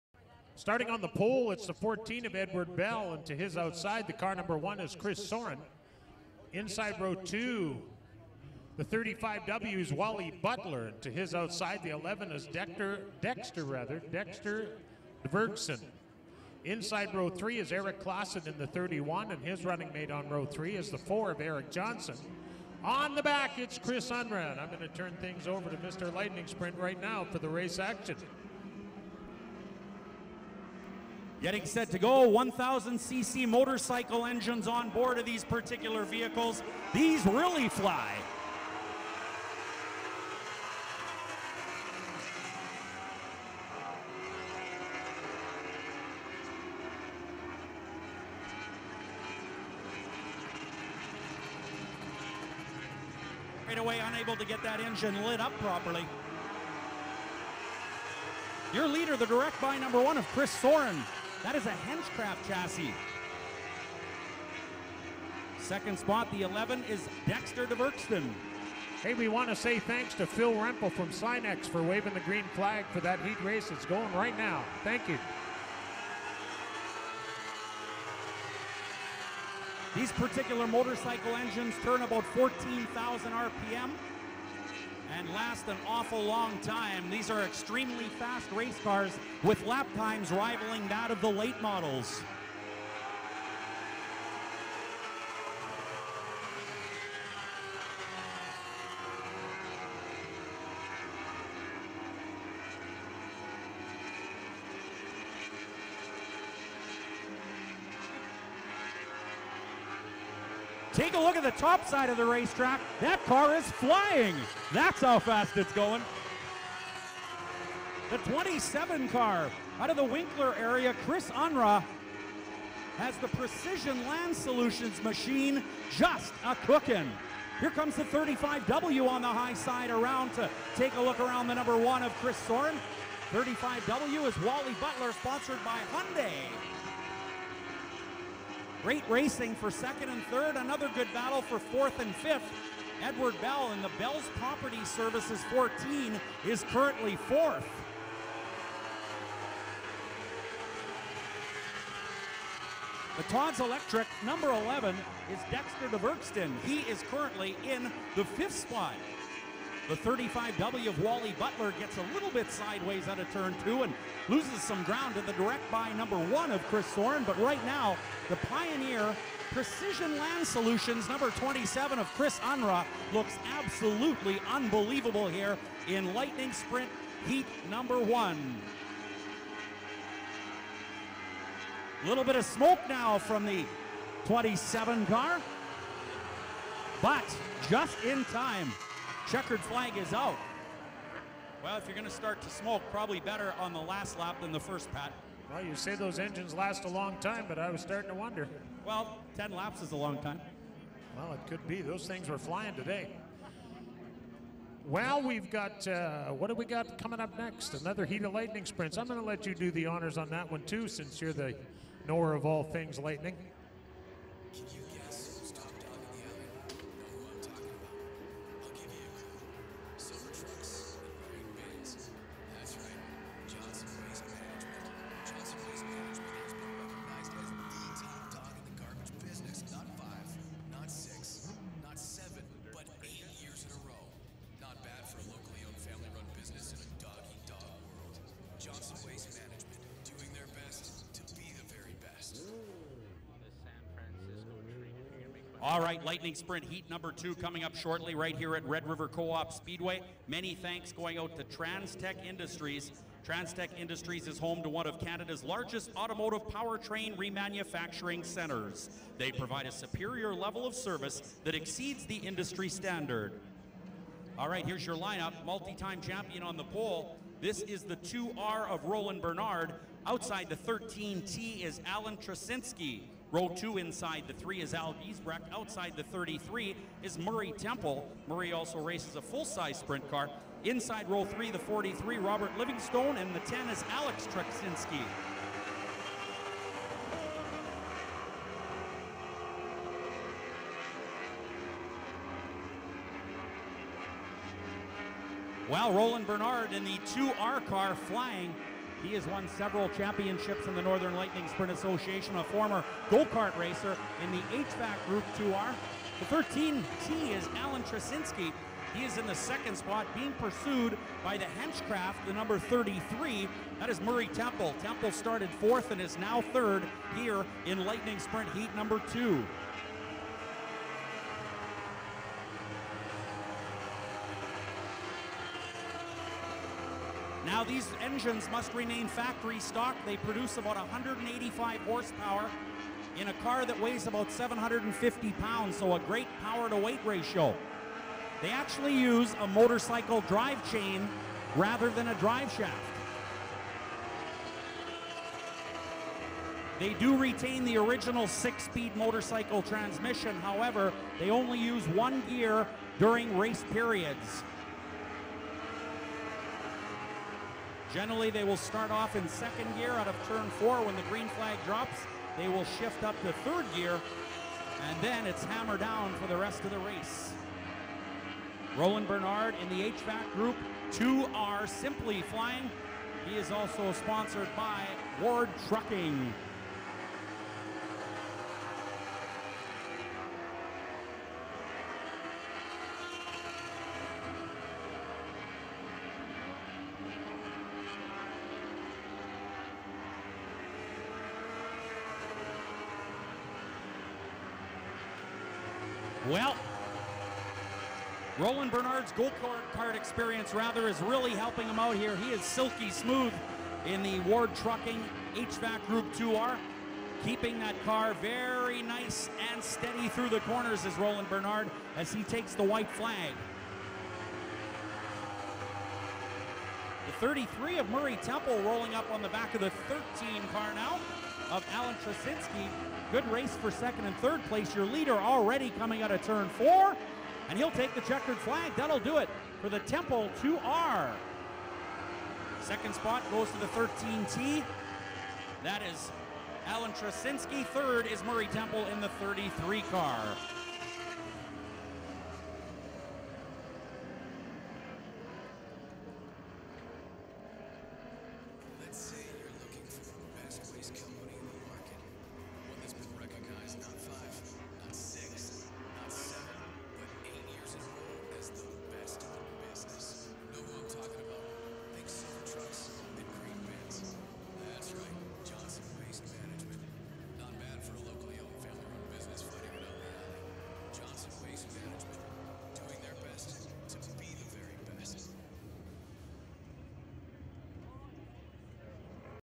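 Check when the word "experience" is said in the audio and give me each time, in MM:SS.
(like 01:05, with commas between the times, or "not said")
06:39.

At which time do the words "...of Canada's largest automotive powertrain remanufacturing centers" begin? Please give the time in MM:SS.
04:14.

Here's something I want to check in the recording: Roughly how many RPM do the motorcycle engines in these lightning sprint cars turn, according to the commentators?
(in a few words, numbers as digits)
14,000.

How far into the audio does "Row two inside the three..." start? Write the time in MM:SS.
04:33.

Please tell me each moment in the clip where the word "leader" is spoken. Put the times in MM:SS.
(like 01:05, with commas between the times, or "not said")
00:58, 07:04.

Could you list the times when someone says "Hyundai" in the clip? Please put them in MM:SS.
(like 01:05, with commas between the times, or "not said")
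02:15.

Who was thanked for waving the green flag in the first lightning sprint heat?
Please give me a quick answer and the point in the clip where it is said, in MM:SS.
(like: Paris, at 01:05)
Phil Rempel, at 01:10.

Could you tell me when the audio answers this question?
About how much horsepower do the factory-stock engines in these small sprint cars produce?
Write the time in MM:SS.
05:30.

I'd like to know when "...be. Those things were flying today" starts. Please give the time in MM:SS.
03:21.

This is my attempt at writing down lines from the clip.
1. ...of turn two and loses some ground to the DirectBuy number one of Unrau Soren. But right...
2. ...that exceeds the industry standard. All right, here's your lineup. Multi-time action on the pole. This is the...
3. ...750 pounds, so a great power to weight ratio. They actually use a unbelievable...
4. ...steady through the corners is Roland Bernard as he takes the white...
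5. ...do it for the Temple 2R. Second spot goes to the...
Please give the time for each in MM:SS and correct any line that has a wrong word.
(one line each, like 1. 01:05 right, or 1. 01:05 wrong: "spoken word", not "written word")
1. 02:43 wrong: "Chris", not "Unrau"
2. 04:21 wrong: "champion", not "action"
3. 05:34 wrong: "motorcycle", not "unbelievable"
4. 06:49 right
5. 07:08 right.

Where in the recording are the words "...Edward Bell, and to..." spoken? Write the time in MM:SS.
00:02.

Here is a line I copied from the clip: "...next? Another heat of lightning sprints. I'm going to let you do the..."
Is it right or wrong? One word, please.
right.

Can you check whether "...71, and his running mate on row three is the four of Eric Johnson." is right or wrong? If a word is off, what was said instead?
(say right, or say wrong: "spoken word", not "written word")
wrong: "31", not "71".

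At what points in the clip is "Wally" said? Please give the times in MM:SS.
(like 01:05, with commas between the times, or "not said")
00:09, 02:14, 02:41.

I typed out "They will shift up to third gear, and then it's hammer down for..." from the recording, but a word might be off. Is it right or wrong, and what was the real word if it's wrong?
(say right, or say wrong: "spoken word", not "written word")
right.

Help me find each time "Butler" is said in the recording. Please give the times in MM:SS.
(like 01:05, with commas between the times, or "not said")
00:10, 02:14, 02:41.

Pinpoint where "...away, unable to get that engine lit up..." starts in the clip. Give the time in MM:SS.
00:53.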